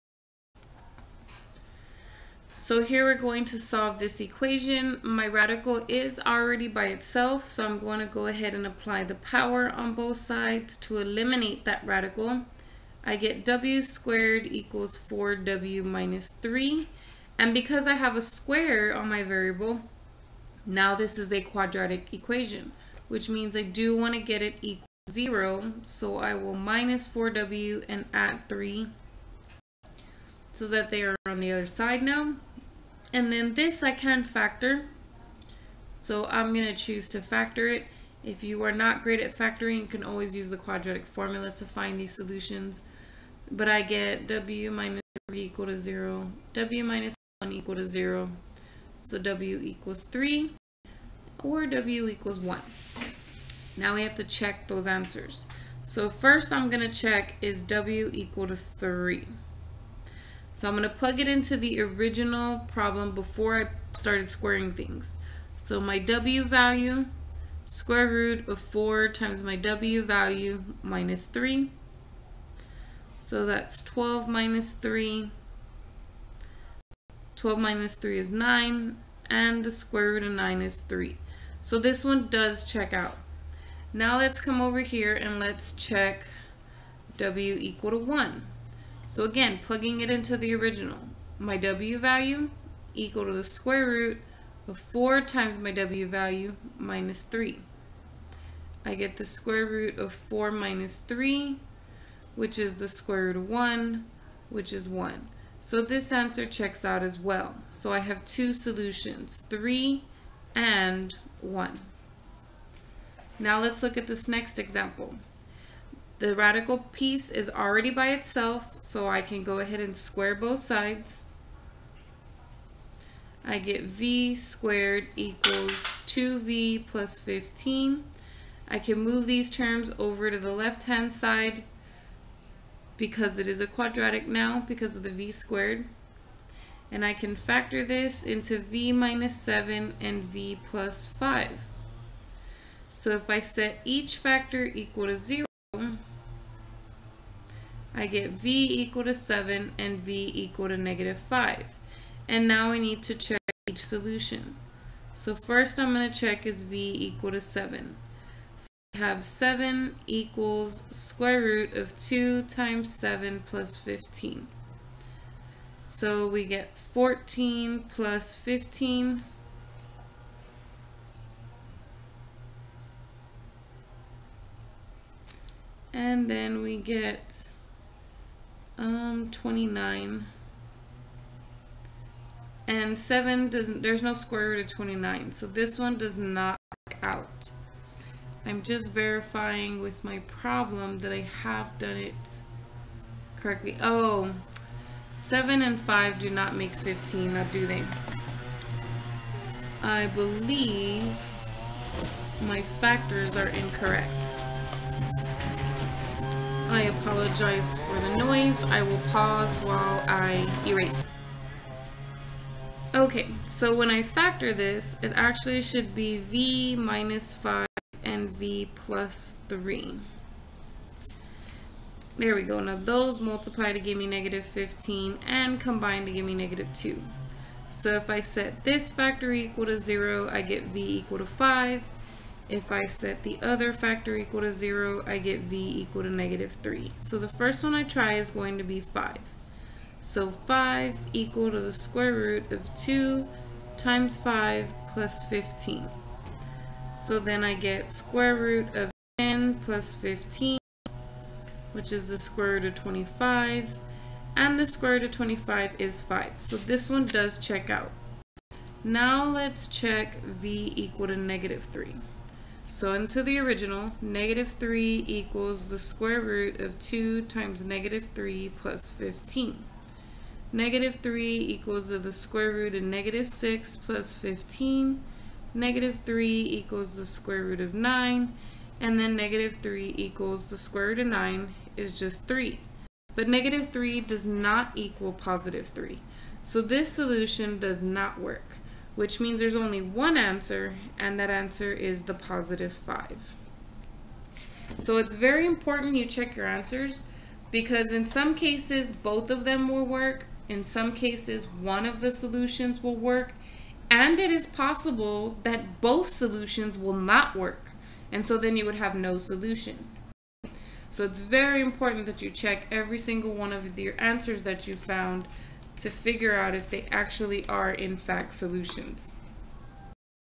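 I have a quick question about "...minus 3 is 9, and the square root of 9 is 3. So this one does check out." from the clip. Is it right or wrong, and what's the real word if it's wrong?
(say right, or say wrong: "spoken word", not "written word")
right.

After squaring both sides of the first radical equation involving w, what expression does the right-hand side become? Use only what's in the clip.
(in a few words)
4w - 3.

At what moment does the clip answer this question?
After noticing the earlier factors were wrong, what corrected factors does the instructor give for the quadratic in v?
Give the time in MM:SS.
03:36.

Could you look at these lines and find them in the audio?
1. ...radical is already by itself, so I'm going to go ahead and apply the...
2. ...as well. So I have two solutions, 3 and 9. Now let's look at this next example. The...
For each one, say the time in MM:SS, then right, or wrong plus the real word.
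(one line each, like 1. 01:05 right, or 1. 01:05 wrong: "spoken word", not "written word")
1. 00:05 right
2. 01:47 wrong: "1", not "9".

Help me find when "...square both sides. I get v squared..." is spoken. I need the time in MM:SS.
01:59.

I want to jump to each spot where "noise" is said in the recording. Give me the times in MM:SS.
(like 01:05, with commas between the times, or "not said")
03:28.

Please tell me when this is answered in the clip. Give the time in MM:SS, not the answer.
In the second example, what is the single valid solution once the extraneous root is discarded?
04:52.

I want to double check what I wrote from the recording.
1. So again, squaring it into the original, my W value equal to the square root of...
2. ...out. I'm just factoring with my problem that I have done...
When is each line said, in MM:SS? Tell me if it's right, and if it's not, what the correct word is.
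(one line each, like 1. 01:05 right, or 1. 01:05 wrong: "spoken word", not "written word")
1. 01:29 wrong: "plugging", not "squaring"
2. 03:07 wrong: "verifying", not "factoring".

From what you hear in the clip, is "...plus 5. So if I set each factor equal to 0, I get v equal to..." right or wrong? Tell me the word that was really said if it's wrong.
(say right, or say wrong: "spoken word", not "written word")
right.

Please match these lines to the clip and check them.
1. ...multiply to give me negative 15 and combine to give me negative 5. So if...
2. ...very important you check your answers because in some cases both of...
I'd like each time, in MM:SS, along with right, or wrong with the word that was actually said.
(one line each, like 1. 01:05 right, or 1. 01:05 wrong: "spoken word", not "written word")
1. 03:43 wrong: "2", not "5"
2. 04:55 right.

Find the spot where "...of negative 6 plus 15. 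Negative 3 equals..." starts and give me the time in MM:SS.
04:32.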